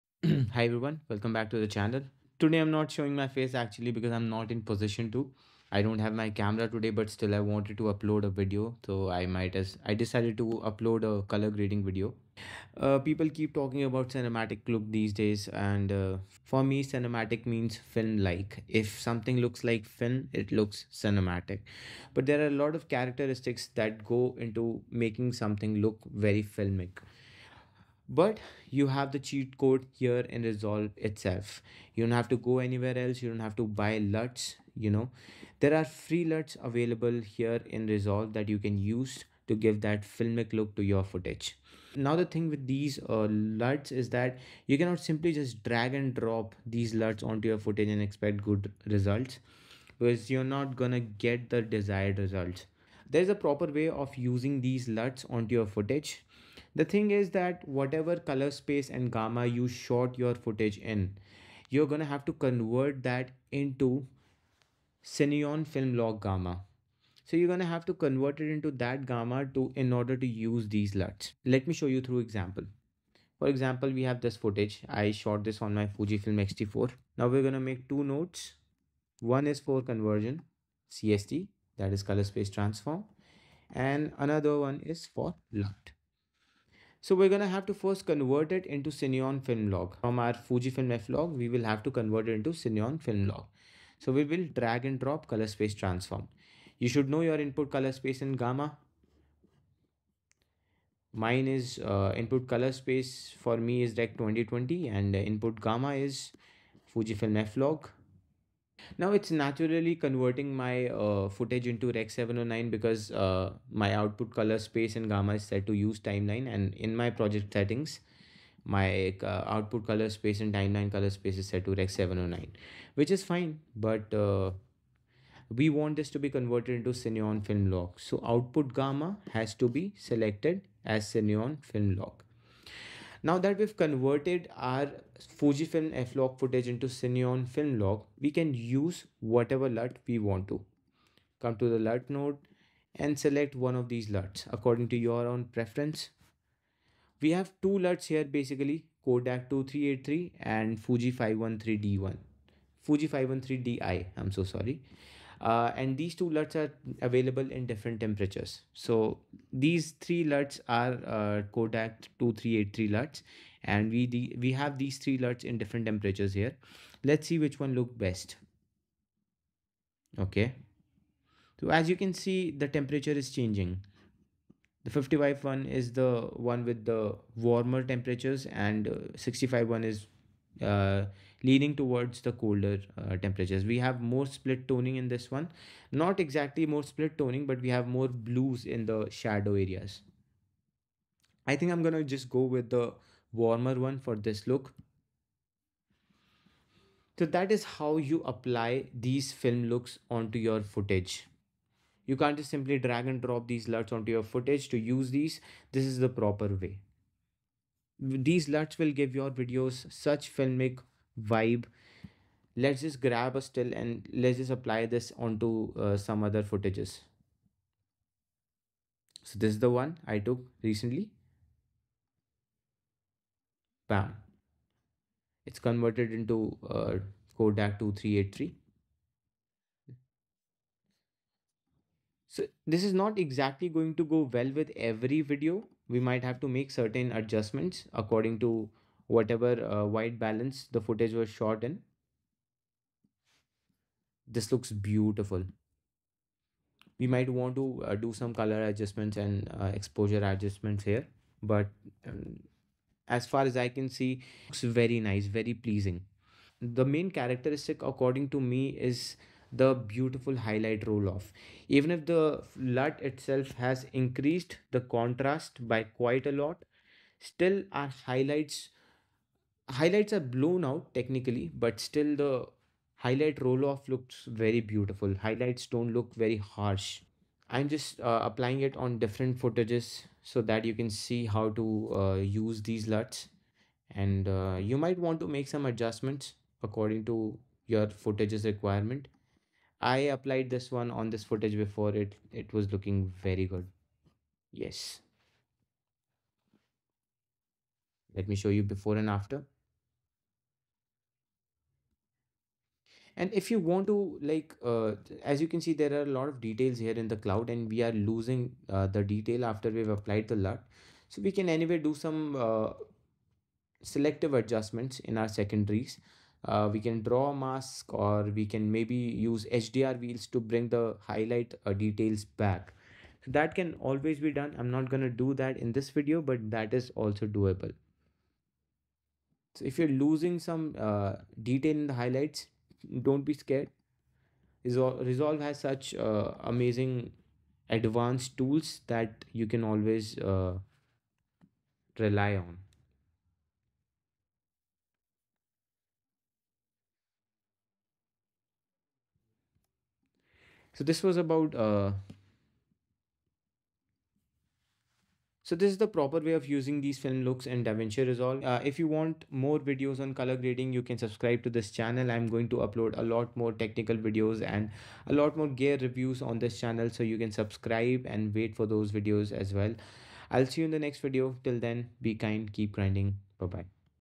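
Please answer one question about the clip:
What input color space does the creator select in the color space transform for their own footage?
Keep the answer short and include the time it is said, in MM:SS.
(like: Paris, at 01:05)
Rec 2020, at 01:43.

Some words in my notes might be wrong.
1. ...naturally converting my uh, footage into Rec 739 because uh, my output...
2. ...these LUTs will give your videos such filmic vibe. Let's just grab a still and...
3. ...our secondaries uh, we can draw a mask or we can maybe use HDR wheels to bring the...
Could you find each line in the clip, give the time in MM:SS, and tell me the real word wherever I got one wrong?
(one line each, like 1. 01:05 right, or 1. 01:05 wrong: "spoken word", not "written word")
1. 01:49 wrong: "709", not "739"
2. 03:28 right
3. 05:15 right.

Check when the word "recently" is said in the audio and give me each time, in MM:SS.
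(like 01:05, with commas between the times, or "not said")
03:40.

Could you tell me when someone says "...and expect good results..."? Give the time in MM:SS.
00:47.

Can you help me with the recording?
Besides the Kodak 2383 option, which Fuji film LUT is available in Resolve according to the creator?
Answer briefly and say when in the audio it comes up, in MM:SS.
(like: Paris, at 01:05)
Fuji 513D1, at 02:32.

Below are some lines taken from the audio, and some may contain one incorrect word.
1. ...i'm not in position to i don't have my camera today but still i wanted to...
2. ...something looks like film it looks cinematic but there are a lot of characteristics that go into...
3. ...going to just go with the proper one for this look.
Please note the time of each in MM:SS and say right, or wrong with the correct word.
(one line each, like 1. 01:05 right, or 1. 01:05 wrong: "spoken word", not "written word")
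1. 00:04 right
2. 00:18 right
3. 03:11 wrong: "warmer", not "proper".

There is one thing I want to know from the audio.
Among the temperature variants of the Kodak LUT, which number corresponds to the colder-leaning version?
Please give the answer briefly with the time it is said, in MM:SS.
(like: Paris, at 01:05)
65, at 02:59.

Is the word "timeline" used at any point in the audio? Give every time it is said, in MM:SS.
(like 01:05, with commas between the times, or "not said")
01:55, 02:00.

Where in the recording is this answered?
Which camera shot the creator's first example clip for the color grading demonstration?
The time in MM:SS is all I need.
01:15.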